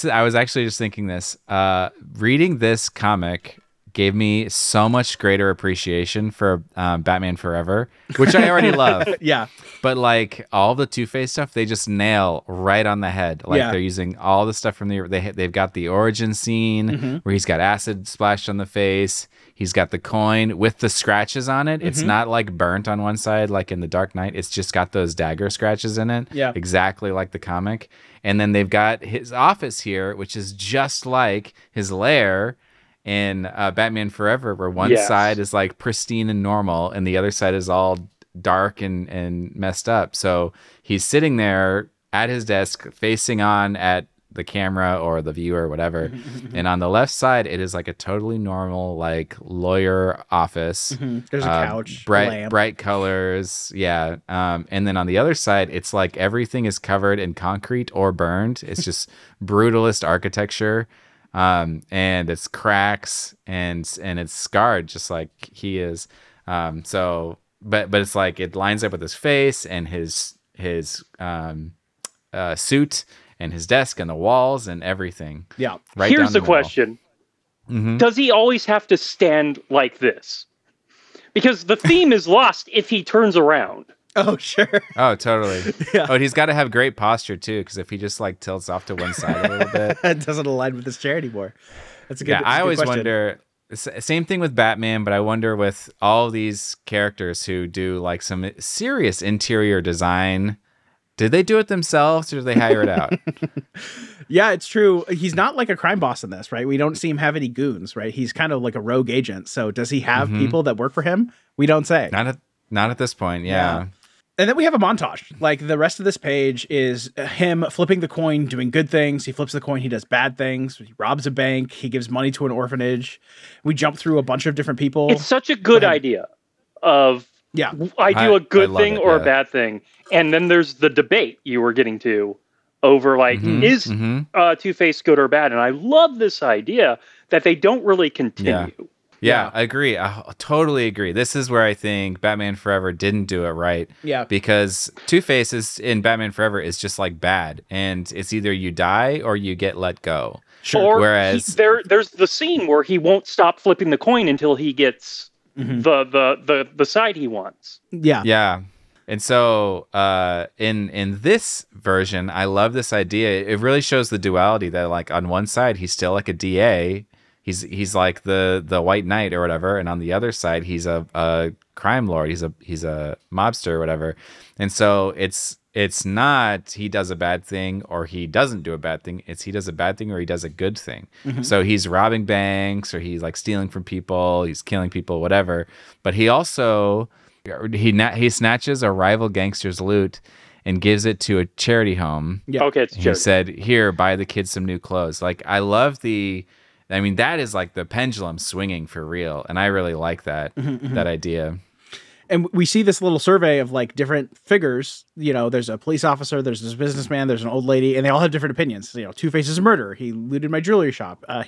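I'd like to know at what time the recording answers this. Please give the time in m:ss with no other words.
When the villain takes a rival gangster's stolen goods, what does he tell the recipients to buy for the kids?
3:14.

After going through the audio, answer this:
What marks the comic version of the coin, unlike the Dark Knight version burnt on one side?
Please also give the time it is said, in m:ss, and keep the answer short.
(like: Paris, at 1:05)
dagger scratches, at 0:25.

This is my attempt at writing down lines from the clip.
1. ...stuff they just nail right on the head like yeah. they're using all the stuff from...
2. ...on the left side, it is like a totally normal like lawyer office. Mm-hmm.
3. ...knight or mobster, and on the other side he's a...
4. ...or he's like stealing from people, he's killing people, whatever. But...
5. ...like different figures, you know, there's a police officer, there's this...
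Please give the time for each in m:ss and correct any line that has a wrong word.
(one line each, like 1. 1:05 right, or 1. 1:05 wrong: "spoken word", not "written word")
1. 0:11 right
2. 0:46 right
3. 2:49 wrong: "whatever", not "mobster"
4. 3:02 right
5. 3:23 right.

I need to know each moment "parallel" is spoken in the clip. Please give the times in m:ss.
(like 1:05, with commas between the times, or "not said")
not said.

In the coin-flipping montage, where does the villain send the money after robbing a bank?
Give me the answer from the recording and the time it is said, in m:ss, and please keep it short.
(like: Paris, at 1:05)
an orphanage, at 2:02.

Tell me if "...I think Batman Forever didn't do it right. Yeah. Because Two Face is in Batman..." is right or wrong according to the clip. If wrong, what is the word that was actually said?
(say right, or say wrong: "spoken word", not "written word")
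right.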